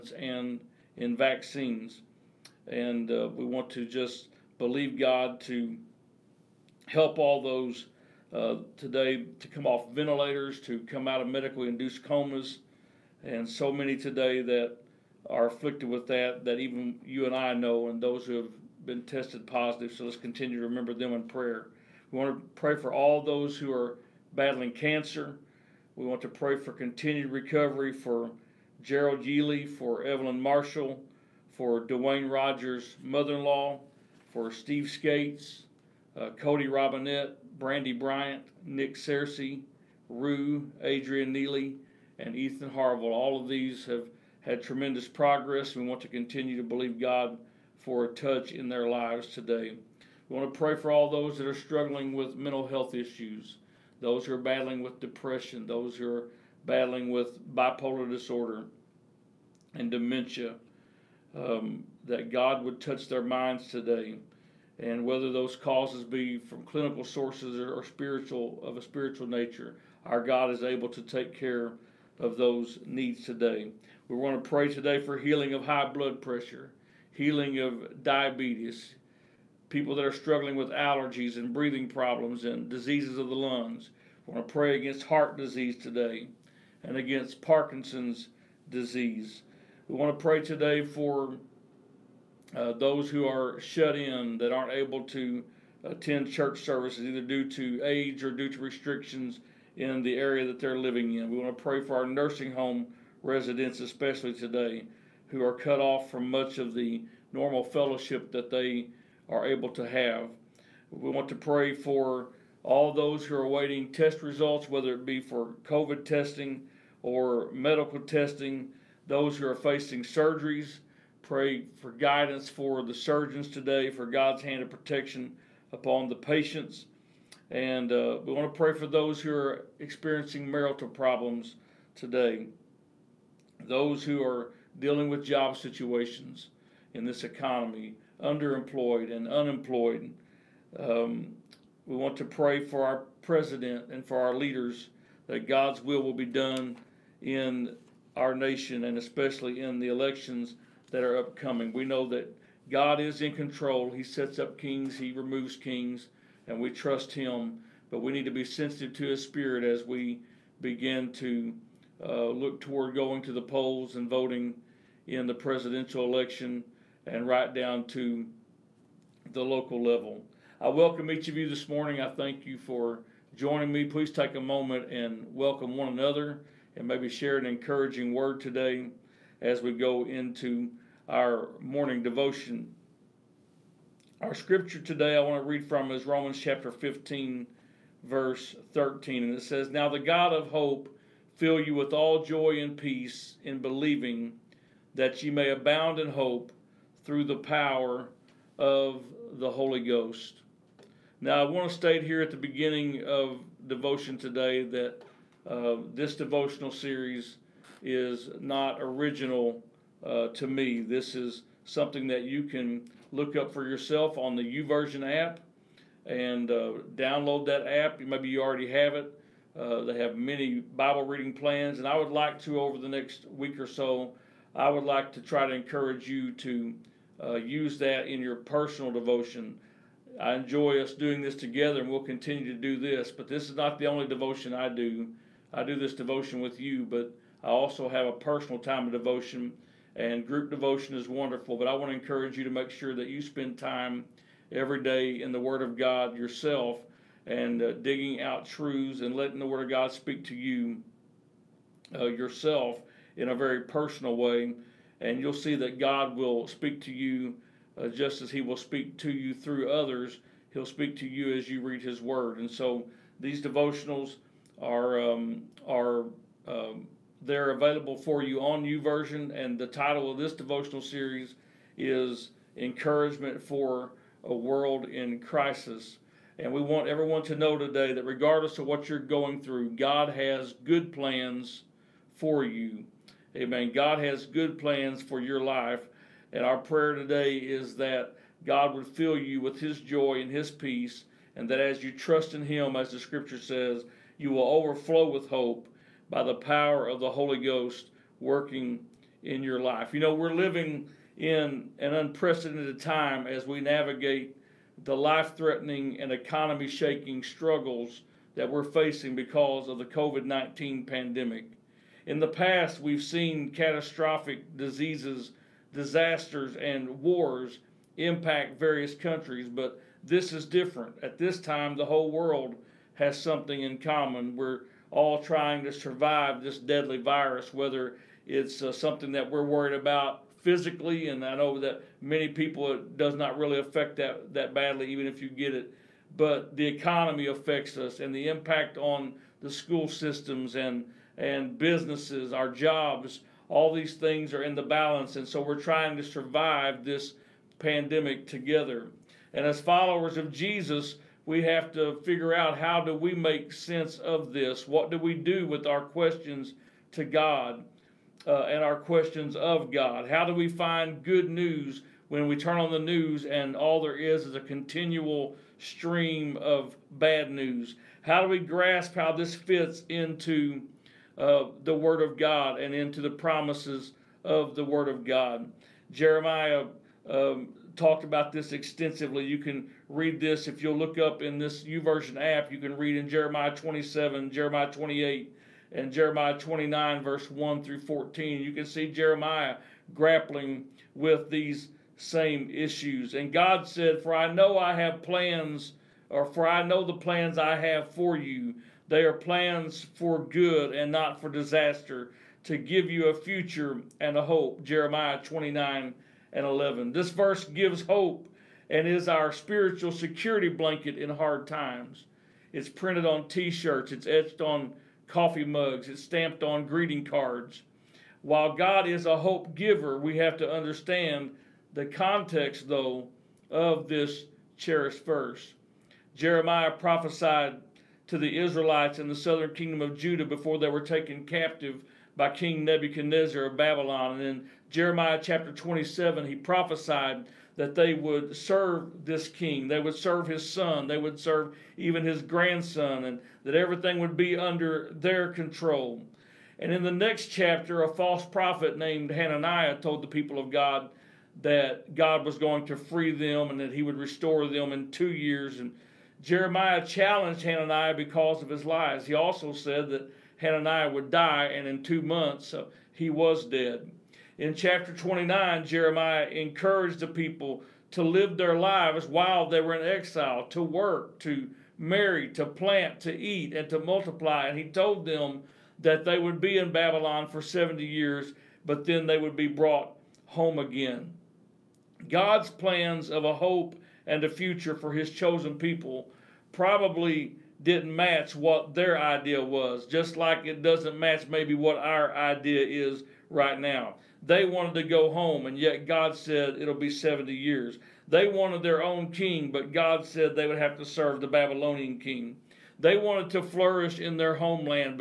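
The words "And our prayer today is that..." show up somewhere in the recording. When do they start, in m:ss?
4:46.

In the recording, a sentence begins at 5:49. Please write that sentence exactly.
And as followers of Jesus, we have to figure out how do we make sense of this?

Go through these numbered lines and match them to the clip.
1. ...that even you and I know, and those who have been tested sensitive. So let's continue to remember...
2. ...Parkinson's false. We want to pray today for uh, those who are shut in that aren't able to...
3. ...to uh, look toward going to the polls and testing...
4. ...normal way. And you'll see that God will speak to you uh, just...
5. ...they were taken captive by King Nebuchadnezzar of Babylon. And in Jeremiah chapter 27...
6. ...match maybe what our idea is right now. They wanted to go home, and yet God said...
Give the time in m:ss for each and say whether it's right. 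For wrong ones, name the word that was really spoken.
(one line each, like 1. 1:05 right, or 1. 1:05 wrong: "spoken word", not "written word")
1. 0:16 wrong: "positive", not "sensitive"
2. 1:27 wrong: "disease", not "false"
3. 2:41 wrong: "voting", not "testing"
4. 4:13 wrong: "personal", not "normal"
5. 7:10 right
6. 8:10 right.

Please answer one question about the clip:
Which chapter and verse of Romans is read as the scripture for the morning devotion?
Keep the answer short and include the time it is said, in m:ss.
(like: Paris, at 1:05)
Romans 15:13, at 3:06.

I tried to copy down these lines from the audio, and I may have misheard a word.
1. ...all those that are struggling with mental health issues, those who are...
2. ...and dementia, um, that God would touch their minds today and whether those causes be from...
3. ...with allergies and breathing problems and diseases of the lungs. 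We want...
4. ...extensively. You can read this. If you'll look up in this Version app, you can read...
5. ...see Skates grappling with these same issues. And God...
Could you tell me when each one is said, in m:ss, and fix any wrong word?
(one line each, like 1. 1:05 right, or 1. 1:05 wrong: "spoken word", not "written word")
1. 0:50 right
2. 0:59 right
3. 1:20 right
4. 6:18 right
5. 6:28 wrong: "Jeremiah", not "Skates".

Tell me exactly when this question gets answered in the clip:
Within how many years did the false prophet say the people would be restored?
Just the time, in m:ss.
7:34.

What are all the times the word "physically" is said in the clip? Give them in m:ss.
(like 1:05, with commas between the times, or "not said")
5:30.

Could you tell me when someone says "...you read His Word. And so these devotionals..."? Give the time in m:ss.
4:21.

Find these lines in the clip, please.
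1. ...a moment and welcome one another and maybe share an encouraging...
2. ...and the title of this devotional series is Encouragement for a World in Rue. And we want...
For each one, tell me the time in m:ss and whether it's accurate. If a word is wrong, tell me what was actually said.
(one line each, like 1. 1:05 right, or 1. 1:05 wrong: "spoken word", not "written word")
1. 2:54 right
2. 4:29 wrong: "Crisis", not "Rue".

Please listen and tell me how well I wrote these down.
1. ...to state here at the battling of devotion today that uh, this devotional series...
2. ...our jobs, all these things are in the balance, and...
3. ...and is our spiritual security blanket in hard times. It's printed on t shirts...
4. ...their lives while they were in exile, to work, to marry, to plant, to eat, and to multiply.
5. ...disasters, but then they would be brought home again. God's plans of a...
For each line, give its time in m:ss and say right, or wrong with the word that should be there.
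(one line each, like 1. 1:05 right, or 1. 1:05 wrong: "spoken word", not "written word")
1. 3:21 wrong: "beginning", not "battling"
2. 5:42 right
3. 6:48 right
4. 7:48 right
5. 7:57 wrong: "years", not "disasters".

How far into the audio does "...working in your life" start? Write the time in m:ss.
4:58.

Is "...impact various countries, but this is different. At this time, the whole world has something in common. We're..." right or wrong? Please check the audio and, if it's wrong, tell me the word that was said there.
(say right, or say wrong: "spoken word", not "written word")
right.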